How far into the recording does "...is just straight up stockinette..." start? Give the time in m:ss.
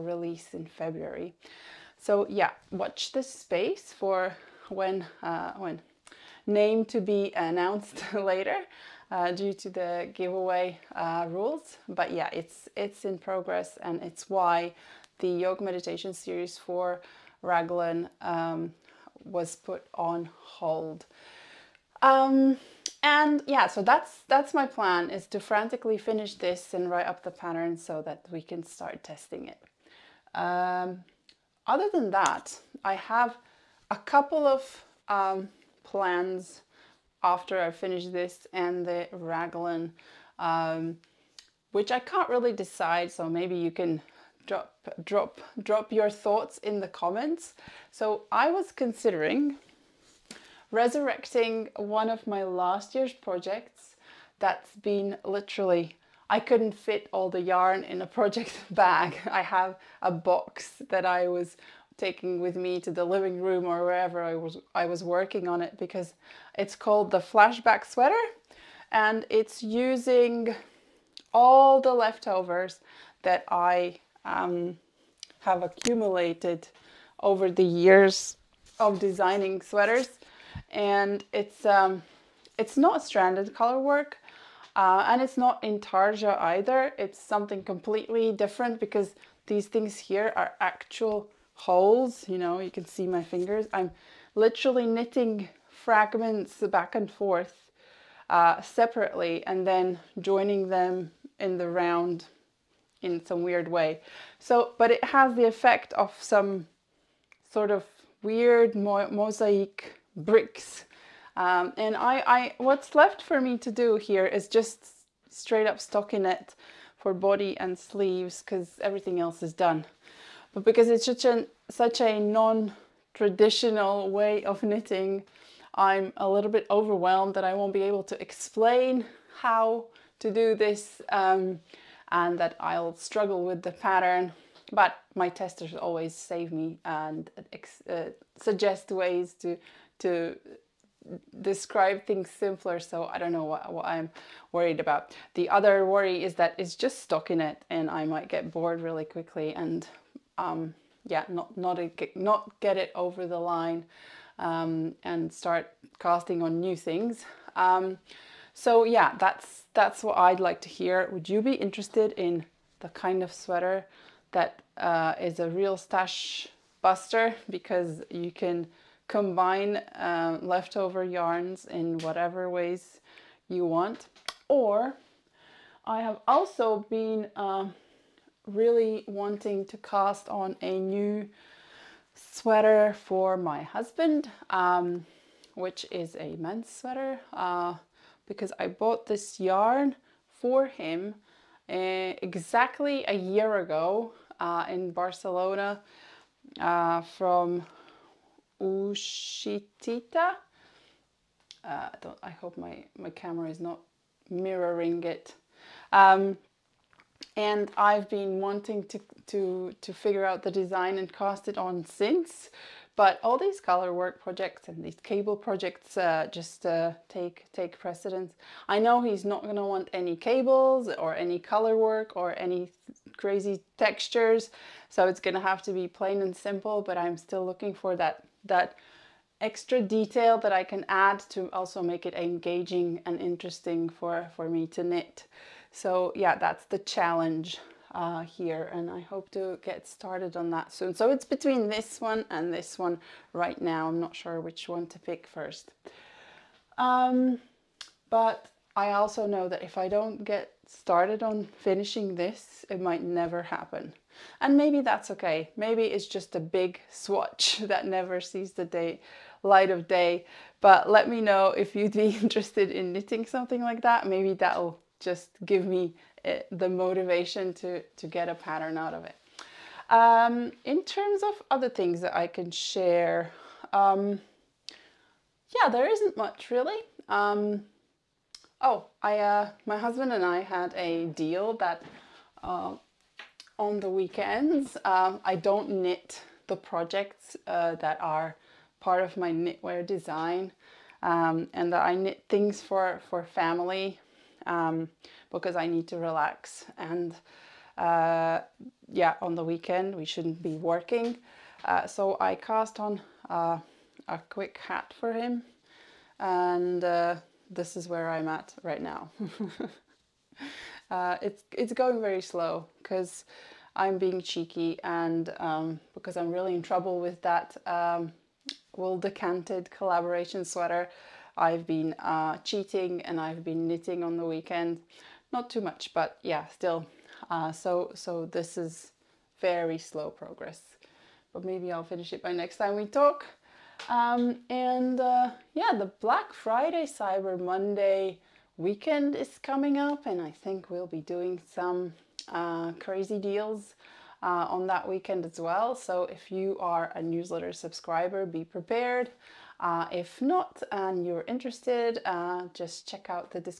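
1:54.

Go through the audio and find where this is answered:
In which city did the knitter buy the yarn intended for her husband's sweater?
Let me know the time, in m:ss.
3:14.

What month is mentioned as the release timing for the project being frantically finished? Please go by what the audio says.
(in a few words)
February.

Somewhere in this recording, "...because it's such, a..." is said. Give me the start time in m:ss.
2:00.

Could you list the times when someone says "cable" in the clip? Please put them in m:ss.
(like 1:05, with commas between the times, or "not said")
3:35, 3:40.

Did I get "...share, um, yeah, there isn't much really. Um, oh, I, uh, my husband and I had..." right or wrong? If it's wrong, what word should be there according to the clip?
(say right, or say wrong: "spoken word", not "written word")
right.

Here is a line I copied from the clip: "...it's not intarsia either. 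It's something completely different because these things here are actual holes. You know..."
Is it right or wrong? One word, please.
right.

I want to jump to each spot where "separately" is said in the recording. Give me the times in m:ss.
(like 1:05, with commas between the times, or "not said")
1:38.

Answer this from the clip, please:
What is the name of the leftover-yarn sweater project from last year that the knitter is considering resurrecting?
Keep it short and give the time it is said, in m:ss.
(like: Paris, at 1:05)
Flashback sweater, at 1:07.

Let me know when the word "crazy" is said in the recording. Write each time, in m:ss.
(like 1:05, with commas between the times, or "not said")
3:43, 5:42.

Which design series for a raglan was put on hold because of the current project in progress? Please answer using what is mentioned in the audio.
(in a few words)
Yoke meditation series.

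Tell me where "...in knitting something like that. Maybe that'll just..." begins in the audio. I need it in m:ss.
4:22.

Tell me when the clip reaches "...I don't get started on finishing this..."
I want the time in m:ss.
4:09.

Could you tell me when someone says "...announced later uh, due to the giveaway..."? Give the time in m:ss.
0:07.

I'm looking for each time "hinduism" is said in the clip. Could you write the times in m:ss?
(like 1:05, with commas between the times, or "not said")
not said.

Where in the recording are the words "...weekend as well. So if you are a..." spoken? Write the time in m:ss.
5:44.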